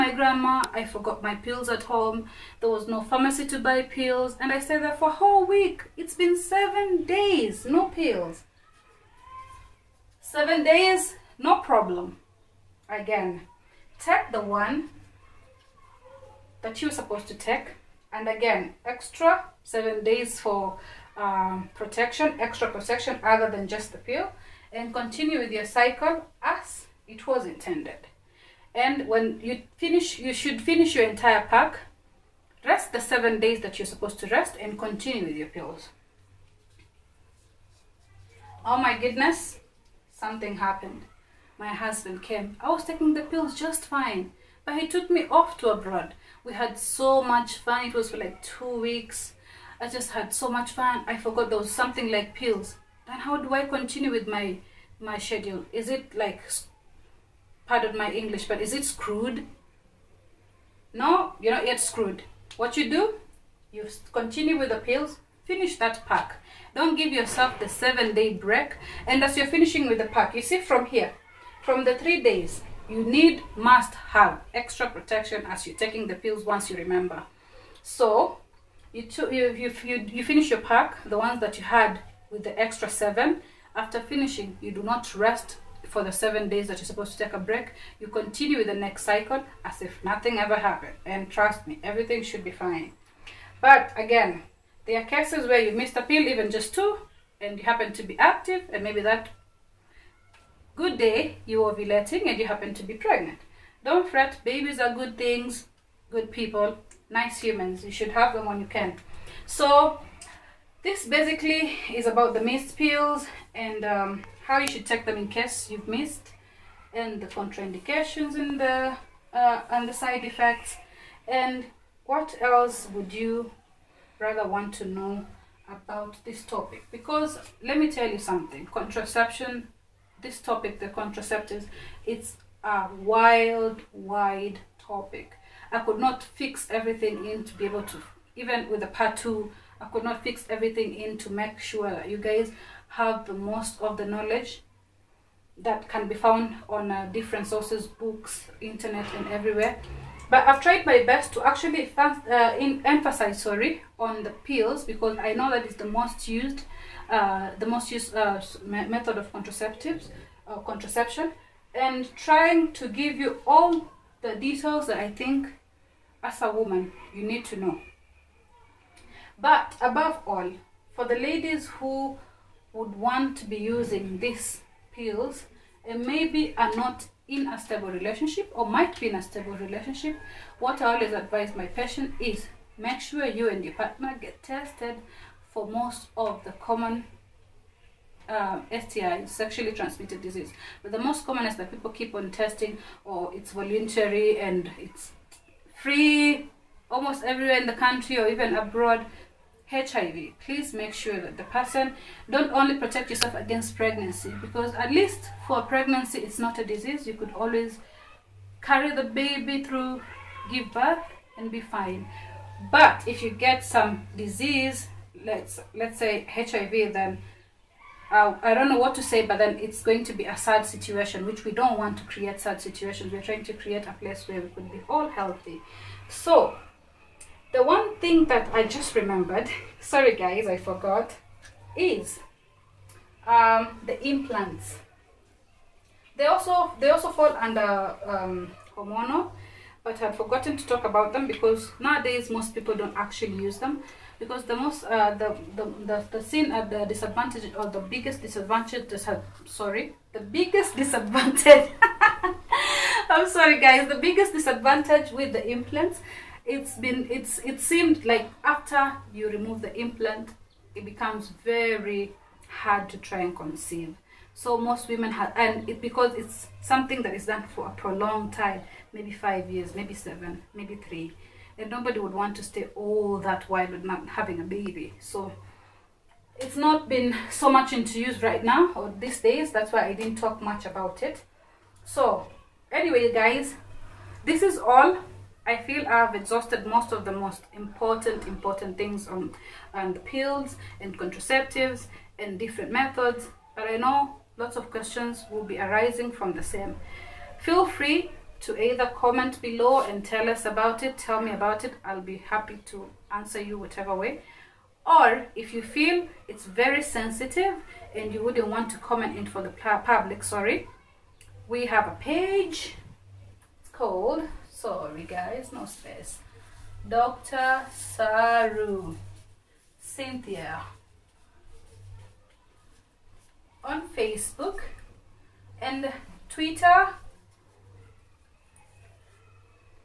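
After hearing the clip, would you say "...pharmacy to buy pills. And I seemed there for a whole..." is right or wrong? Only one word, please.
wrong.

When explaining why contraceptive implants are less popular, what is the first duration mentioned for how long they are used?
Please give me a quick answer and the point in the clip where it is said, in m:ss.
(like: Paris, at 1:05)
5 years, at 4:29.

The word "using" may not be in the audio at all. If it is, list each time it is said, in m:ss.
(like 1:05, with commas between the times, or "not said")
2:53.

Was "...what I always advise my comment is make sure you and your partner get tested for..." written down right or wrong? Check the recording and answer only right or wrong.
wrong.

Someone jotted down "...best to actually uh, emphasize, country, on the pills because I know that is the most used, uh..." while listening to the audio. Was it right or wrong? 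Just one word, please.
wrong.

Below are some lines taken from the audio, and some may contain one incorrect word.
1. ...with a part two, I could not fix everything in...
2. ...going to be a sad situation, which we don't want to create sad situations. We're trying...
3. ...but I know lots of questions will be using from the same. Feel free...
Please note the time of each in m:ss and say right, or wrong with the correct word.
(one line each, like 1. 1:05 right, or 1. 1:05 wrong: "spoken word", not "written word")
1. 2:18 right
2. 3:39 right
3. 4:53 wrong: "arising", not "using".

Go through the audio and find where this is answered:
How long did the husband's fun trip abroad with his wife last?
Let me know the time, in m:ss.
0:48.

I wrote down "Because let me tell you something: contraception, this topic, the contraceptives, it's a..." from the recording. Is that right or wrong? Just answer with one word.
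right.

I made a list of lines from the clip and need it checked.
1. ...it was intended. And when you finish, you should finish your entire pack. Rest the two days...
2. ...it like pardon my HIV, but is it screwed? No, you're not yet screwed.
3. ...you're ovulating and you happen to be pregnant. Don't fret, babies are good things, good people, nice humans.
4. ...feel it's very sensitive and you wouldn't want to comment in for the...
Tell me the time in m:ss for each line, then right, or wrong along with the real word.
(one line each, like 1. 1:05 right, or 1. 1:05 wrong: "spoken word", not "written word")
1. 0:27 wrong: "seven", not "two"
2. 0:55 wrong: "English", not "HIV"
3. 1:41 right
4. 5:05 right.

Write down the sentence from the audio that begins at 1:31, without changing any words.
And trust me, everything should be fine.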